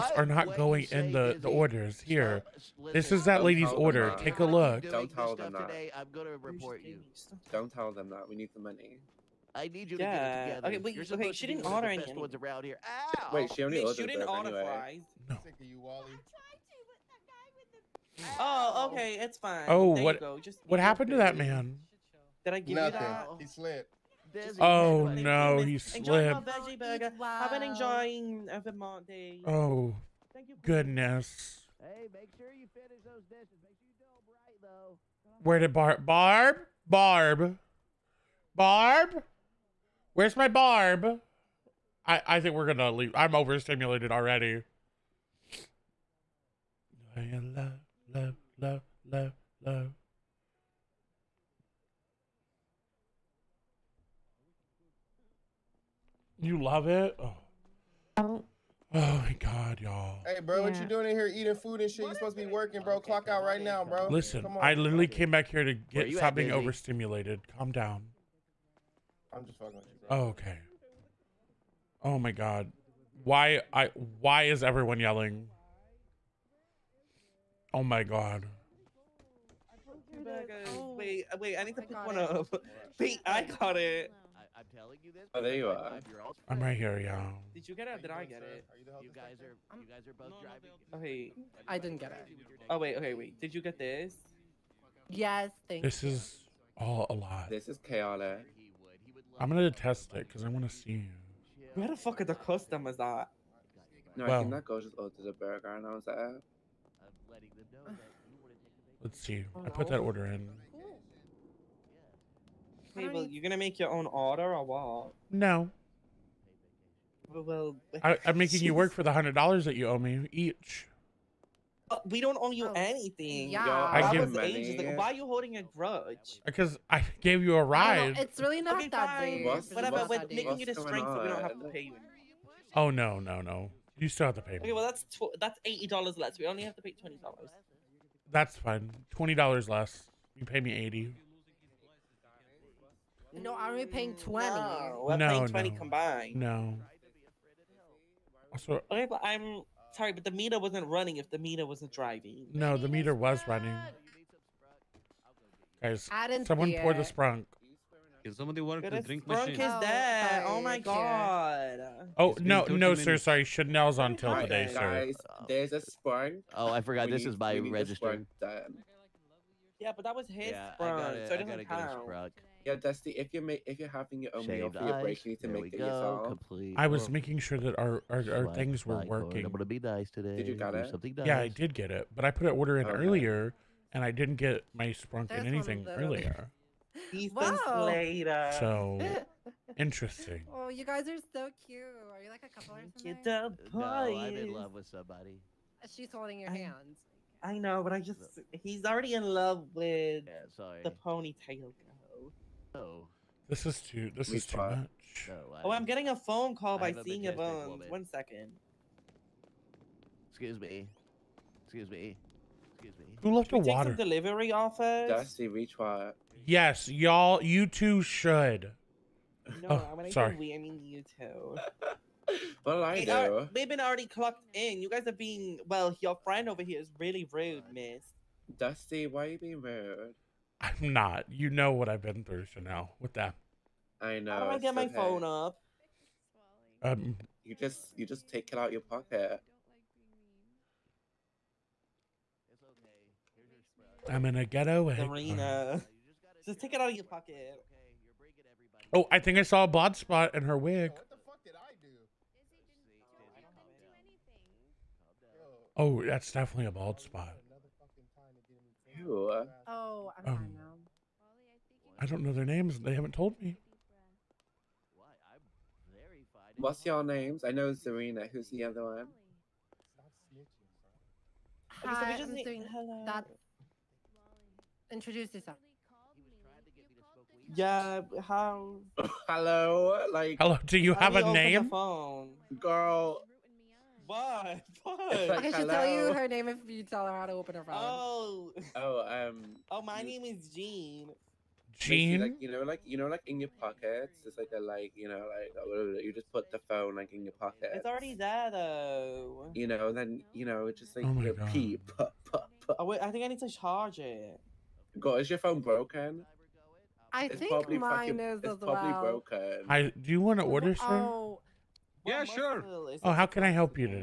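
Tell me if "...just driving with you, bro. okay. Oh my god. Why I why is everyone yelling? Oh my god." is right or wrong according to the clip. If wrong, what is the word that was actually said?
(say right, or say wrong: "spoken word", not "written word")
wrong: "fucking", not "driving".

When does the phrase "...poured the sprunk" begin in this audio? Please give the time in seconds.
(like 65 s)
156 s.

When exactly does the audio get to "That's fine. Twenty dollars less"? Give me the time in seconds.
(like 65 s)
138 s.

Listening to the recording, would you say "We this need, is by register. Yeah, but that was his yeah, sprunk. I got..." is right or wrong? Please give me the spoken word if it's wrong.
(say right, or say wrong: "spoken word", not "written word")
right.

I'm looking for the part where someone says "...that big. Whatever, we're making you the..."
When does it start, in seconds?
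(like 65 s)
128 s.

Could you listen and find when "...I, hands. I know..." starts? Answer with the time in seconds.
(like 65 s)
196 s.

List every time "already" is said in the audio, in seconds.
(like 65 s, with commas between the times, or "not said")
44 s, 198 s, 223 s, 297 s.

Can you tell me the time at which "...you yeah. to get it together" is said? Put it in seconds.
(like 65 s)
9 s.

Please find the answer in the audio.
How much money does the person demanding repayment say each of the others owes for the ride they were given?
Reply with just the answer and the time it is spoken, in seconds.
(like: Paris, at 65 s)
$100, at 119 s.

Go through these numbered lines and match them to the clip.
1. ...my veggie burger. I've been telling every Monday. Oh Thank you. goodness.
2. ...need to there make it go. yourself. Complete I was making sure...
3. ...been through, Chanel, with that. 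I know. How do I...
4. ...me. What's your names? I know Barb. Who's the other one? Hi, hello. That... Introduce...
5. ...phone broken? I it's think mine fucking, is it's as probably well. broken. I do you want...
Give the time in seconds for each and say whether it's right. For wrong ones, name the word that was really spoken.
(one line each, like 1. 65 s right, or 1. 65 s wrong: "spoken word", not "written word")
1. 26 s wrong: "enjoying", not "telling"
2. 175 s right
3. 232 s right
4. 263 s wrong: "Serena", not "Barb"
5. 305 s right.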